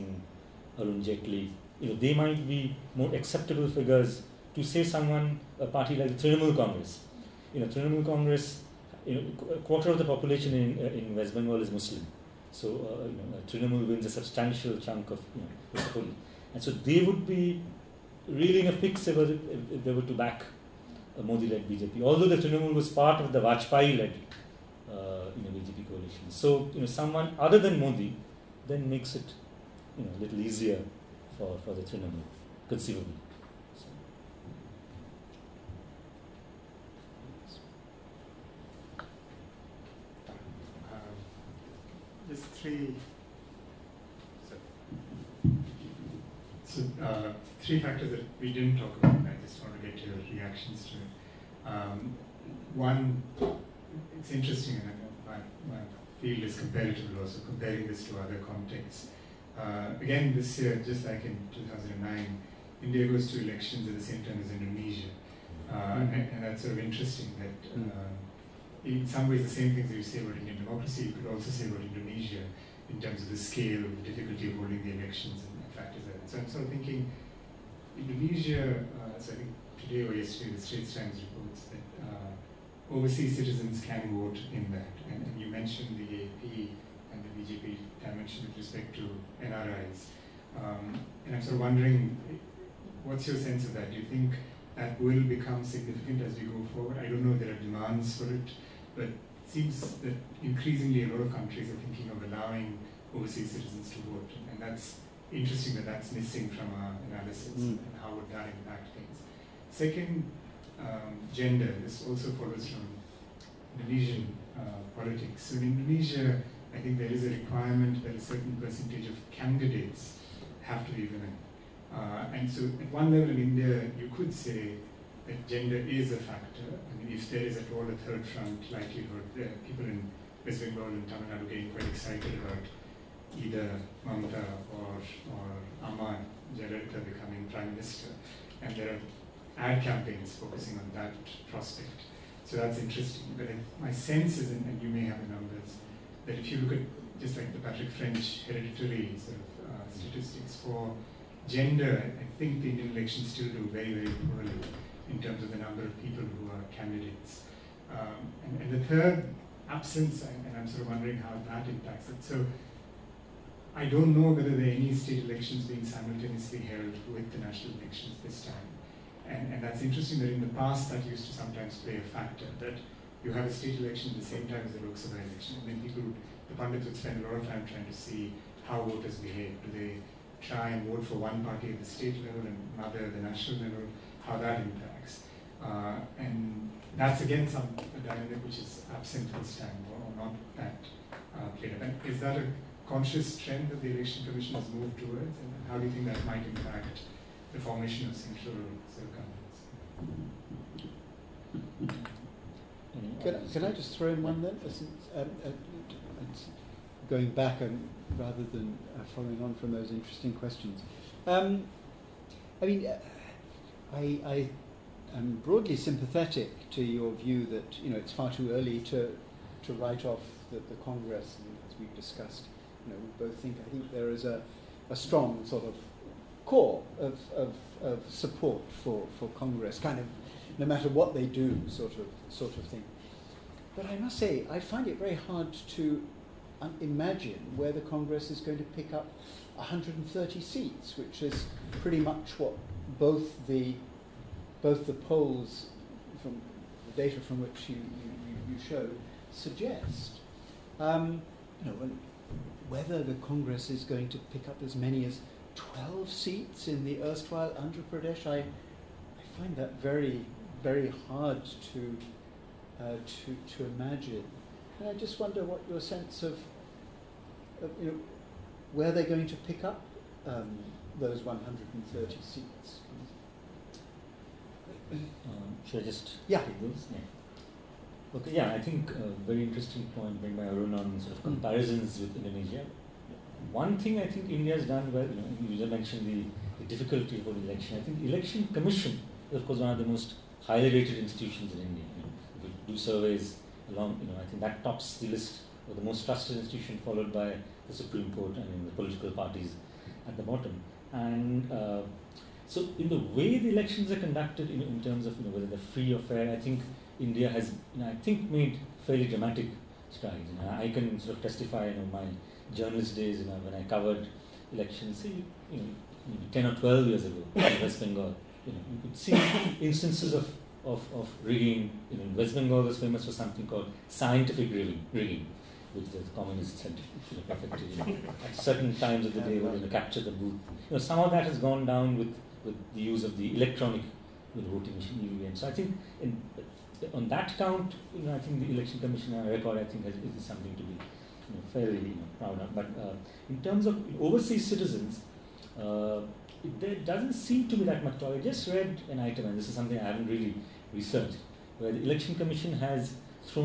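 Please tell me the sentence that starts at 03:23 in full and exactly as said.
Can, can I just throw in one then?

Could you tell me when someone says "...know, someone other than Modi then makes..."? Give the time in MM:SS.
00:26.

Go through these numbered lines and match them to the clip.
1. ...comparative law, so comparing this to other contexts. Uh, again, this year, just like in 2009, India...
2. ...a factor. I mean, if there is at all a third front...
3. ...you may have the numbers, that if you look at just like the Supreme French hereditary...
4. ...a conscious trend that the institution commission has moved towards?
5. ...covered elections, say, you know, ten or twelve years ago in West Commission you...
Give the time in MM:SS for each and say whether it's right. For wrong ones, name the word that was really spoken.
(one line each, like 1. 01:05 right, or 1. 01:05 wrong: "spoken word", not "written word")
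1. 00:56 right
2. 02:06 right
3. 02:24 wrong: "Patrick", not "Supreme"
4. 03:12 wrong: "election", not "institution"
5. 05:13 wrong: "Bengal", not "Commission".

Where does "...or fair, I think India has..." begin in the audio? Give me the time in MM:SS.
05:05.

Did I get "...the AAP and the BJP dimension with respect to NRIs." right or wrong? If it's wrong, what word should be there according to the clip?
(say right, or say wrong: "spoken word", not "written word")
right.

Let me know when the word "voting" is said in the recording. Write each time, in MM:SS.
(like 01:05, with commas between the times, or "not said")
05:34.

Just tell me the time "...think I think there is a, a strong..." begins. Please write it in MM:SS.
03:43.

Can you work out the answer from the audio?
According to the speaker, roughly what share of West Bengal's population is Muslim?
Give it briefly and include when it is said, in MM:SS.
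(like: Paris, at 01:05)
a quarter, at 00:09.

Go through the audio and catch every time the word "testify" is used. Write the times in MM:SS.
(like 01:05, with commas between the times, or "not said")
05:11.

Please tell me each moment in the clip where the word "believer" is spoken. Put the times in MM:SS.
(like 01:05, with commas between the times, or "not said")
not said.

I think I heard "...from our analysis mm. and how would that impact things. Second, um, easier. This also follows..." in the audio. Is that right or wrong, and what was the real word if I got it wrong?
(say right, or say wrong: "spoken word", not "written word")
wrong: "gender", not "easier".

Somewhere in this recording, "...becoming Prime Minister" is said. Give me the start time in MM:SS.
02:17.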